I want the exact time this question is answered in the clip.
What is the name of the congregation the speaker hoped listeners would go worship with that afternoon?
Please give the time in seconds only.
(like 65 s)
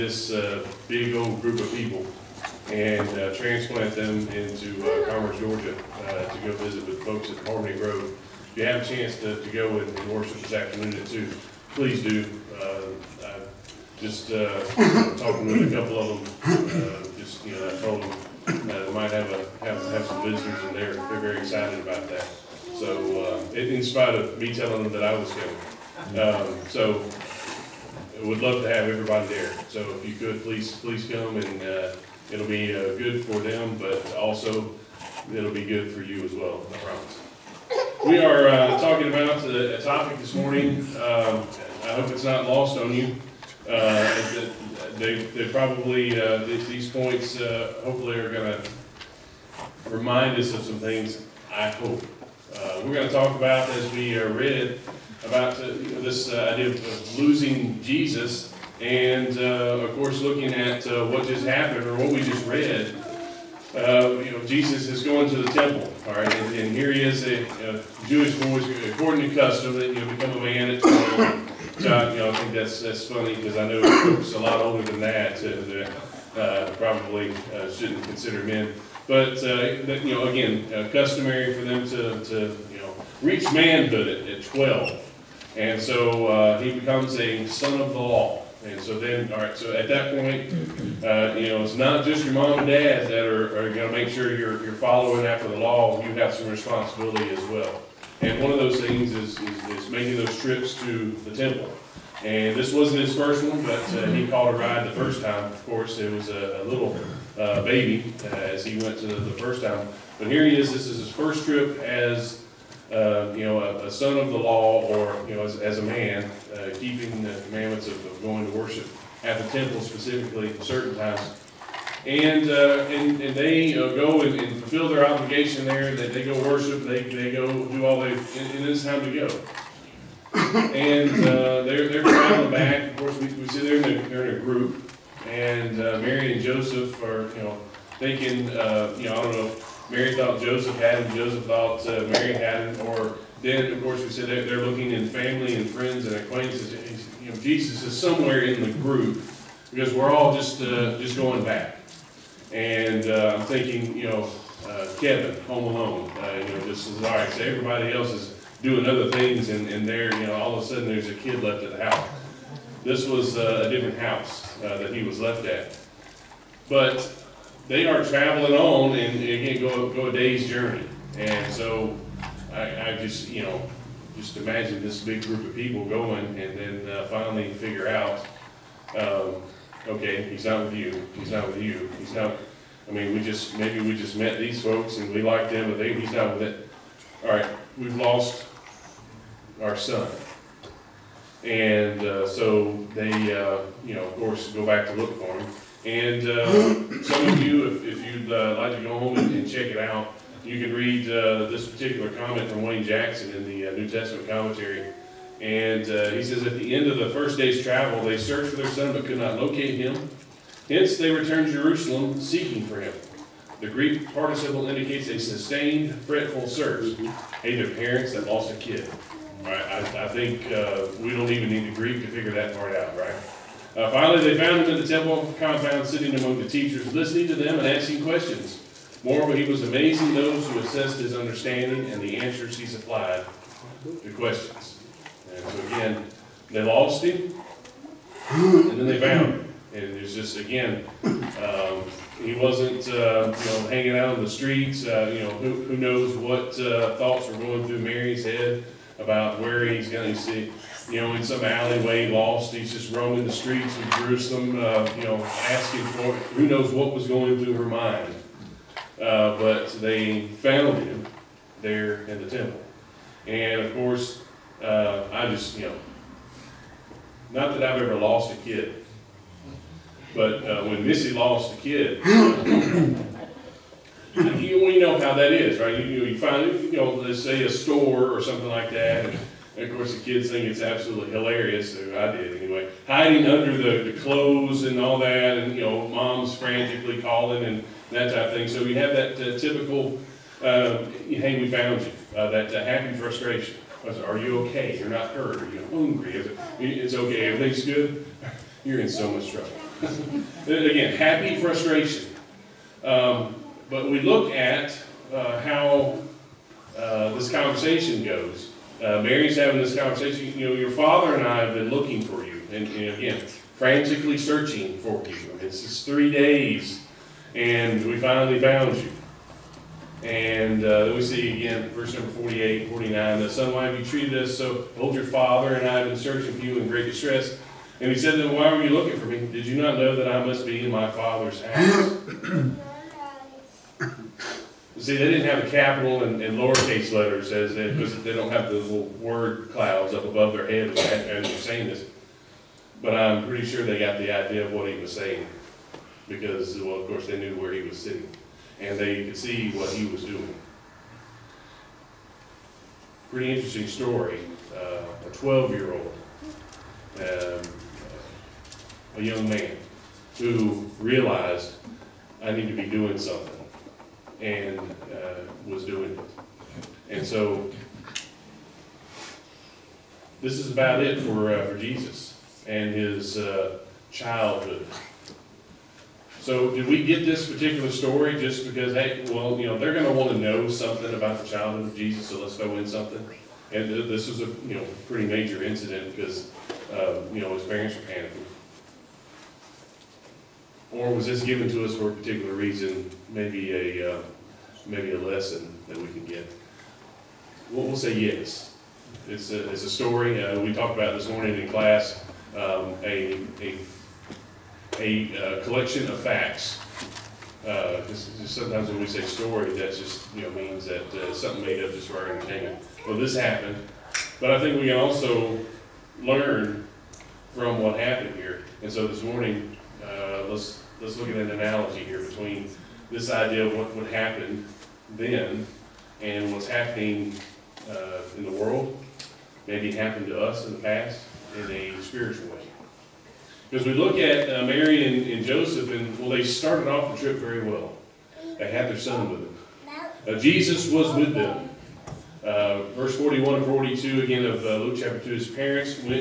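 7 s.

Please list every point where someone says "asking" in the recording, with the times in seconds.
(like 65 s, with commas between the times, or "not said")
227 s, 255 s.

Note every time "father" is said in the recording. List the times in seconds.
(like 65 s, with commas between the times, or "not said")
310 s, 325 s, 330 s.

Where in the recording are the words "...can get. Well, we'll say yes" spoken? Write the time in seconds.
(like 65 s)
395 s.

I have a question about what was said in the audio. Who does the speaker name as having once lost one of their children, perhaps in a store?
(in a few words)
Missy.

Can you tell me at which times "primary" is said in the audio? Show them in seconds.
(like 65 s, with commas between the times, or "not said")
not said.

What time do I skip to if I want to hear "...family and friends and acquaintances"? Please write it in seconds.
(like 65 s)
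145 s.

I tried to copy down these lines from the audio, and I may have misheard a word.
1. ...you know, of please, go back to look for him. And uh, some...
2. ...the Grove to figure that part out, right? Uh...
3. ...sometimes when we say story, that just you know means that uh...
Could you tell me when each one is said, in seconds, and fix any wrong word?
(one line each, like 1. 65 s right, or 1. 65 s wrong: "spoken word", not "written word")
1. 193 s wrong: "course", not "please"
2. 221 s wrong: "Greek", not "Grove"
3. 408 s right.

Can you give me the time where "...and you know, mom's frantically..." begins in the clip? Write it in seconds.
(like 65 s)
285 s.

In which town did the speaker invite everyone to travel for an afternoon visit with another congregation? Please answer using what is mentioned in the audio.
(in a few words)
Commerce, Georgia.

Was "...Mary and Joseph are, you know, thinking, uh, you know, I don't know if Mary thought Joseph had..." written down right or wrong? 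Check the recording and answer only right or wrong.
right.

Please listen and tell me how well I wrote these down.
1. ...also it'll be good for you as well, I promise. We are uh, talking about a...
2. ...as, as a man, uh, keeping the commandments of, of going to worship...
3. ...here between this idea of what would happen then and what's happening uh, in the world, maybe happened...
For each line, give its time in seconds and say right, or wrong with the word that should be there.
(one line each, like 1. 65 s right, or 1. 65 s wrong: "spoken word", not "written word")
1. 34 s right
2. 115 s right
3. 421 s right.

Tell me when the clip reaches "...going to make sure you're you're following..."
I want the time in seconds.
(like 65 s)
93 s.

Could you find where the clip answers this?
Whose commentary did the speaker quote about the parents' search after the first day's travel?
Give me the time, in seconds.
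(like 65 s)
202 s.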